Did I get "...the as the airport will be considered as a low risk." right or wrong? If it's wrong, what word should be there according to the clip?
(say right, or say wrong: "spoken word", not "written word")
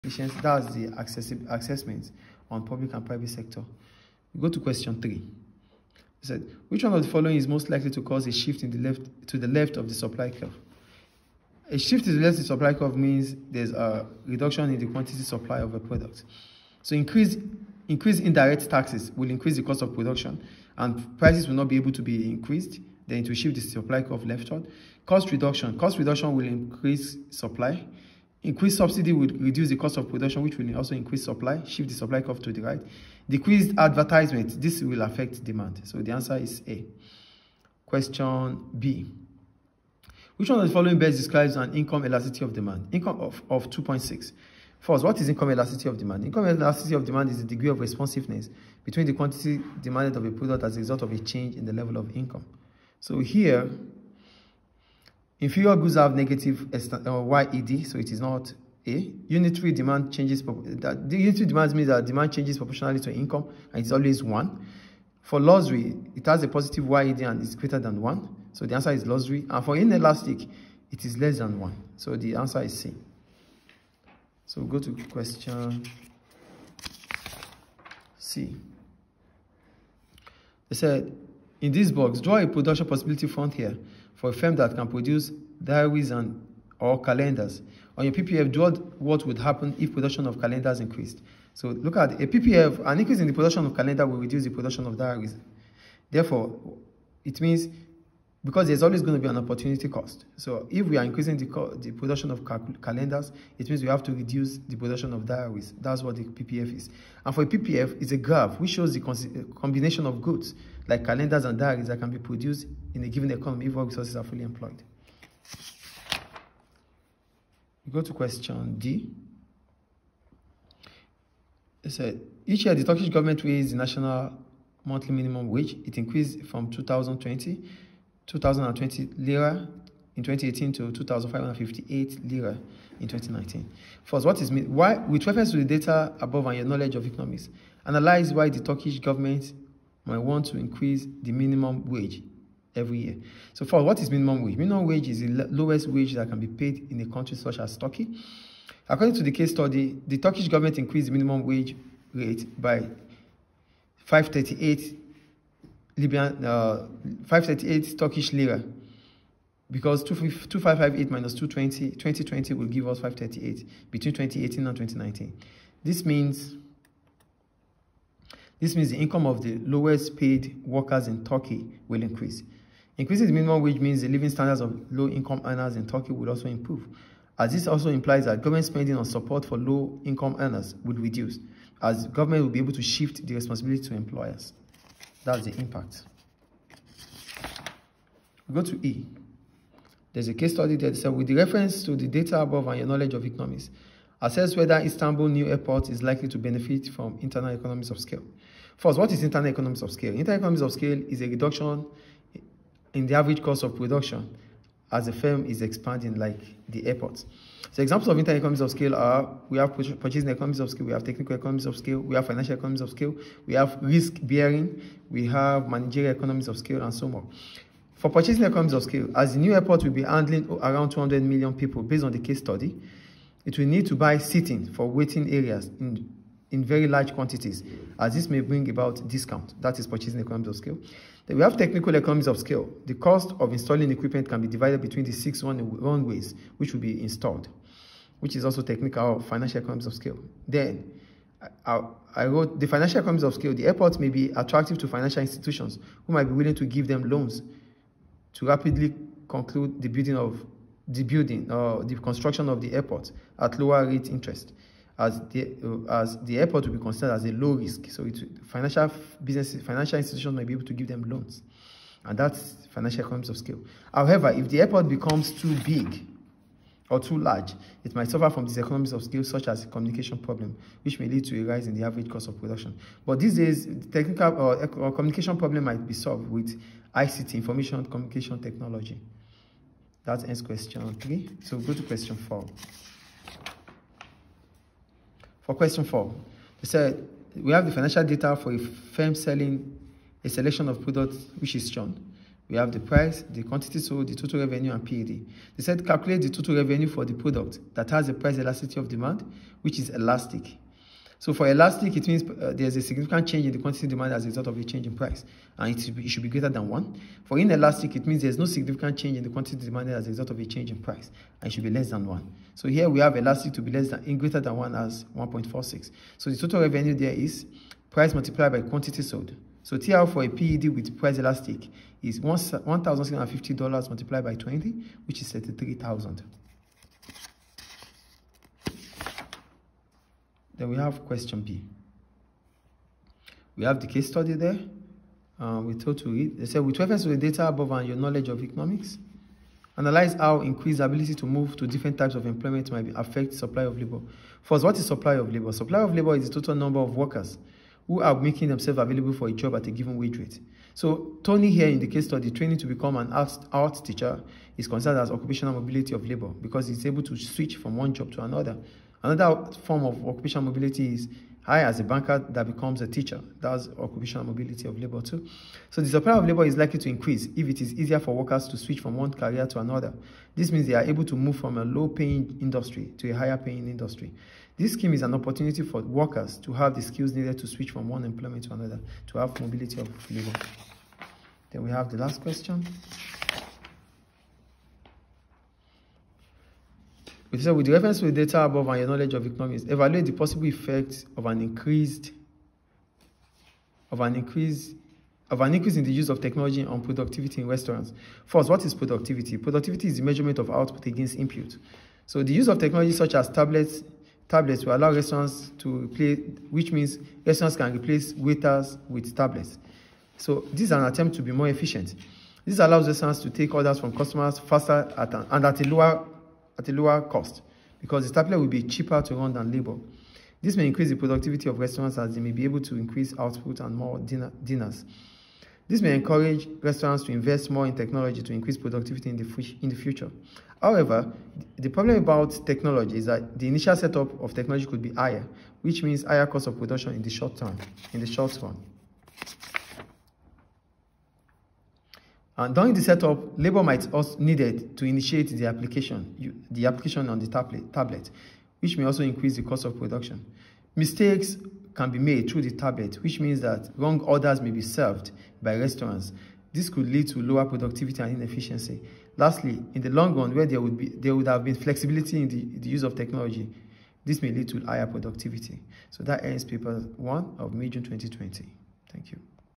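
right.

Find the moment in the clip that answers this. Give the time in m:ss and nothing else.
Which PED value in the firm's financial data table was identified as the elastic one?
5:15.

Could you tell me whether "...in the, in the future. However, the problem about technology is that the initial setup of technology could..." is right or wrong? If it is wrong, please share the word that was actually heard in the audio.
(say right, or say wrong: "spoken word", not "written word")
right.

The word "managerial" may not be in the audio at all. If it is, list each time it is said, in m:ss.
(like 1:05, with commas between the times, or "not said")
3:35.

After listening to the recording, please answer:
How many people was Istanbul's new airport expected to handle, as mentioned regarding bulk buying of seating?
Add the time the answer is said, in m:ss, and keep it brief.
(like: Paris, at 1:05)
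200 million, at 3:40.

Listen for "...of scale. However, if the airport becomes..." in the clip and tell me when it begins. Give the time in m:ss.
4:23.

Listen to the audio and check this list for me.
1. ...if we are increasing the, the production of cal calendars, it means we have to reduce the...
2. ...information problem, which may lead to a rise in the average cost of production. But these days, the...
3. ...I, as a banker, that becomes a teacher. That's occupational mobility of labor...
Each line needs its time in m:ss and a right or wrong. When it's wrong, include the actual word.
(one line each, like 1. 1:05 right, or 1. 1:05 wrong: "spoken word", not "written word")
1. 1:40 right
2. 4:29 wrong: "communication", not "information"
3. 6:01 right.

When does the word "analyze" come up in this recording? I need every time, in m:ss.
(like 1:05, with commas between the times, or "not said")
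2:17, 5:39.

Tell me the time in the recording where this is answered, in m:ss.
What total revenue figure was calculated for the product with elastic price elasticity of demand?
5:25.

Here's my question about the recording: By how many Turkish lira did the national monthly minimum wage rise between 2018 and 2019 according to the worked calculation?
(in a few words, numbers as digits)
538.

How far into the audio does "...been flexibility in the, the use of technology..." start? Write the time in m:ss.
7:41.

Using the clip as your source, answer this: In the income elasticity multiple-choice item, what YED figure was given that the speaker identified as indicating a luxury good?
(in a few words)
2.6.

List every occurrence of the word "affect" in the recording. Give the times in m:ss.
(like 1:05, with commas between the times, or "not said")
0:35, 5:42.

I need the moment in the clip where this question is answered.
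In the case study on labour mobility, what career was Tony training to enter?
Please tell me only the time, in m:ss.
5:53.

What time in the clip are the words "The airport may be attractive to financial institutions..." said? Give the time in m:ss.
4:03.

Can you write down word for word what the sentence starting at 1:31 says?
So look at a PPF, an increase in the production of calendar will reduce the production of diaries.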